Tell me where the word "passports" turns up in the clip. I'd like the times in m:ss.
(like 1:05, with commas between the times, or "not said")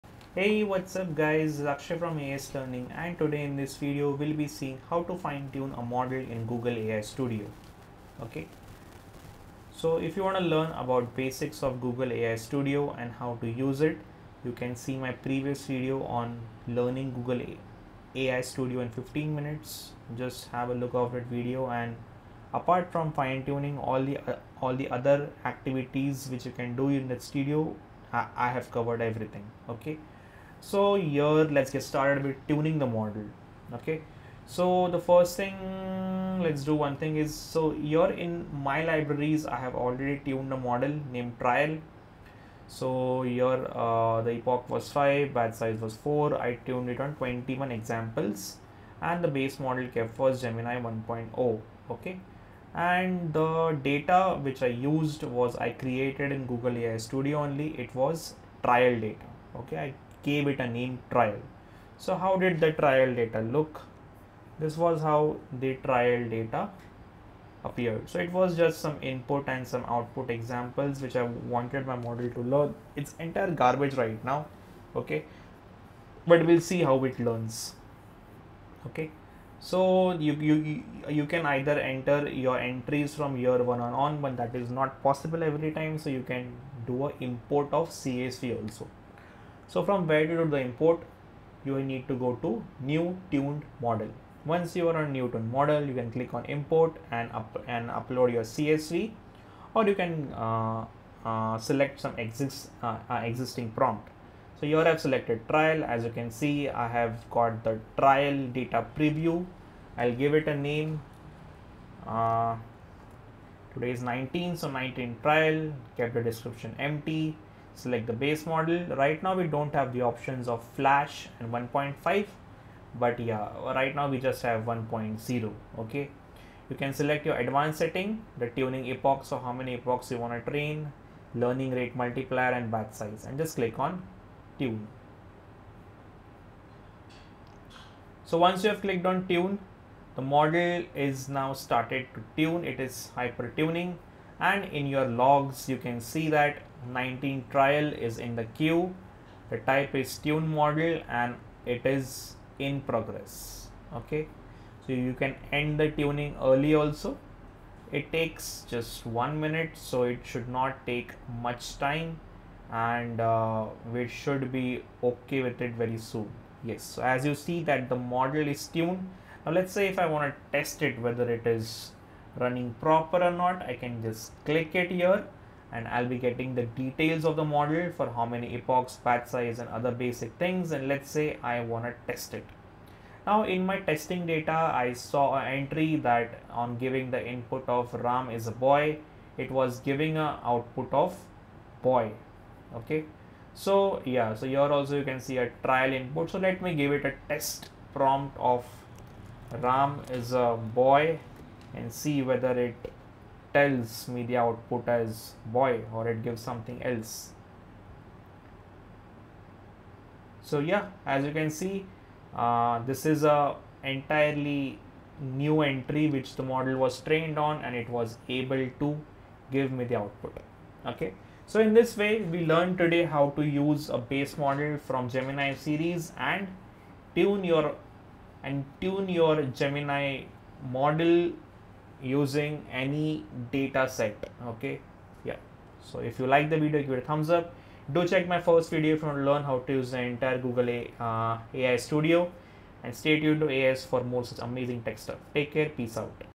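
not said.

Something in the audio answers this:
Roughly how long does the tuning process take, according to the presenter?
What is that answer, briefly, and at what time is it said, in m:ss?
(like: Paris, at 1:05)
one minute, at 2:39.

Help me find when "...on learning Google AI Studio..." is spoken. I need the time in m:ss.
0:16.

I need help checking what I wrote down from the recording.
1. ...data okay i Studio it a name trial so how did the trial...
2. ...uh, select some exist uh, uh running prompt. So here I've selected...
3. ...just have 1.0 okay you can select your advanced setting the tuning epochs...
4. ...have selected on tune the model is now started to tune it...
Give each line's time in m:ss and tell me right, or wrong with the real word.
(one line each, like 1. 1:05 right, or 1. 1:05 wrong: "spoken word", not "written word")
1. 0:59 wrong: "Gave", not "Studio"
2. 1:41 wrong: "existing", not "running"
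3. 2:04 right
4. 2:18 wrong: "clicked", not "selected".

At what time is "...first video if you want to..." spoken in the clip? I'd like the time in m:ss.
3:58.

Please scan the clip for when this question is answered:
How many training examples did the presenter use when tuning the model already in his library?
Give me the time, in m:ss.
0:47.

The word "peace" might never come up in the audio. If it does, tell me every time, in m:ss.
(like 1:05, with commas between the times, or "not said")
4:05.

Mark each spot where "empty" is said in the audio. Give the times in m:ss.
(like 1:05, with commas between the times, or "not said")
1:56.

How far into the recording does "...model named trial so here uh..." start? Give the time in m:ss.
0:40.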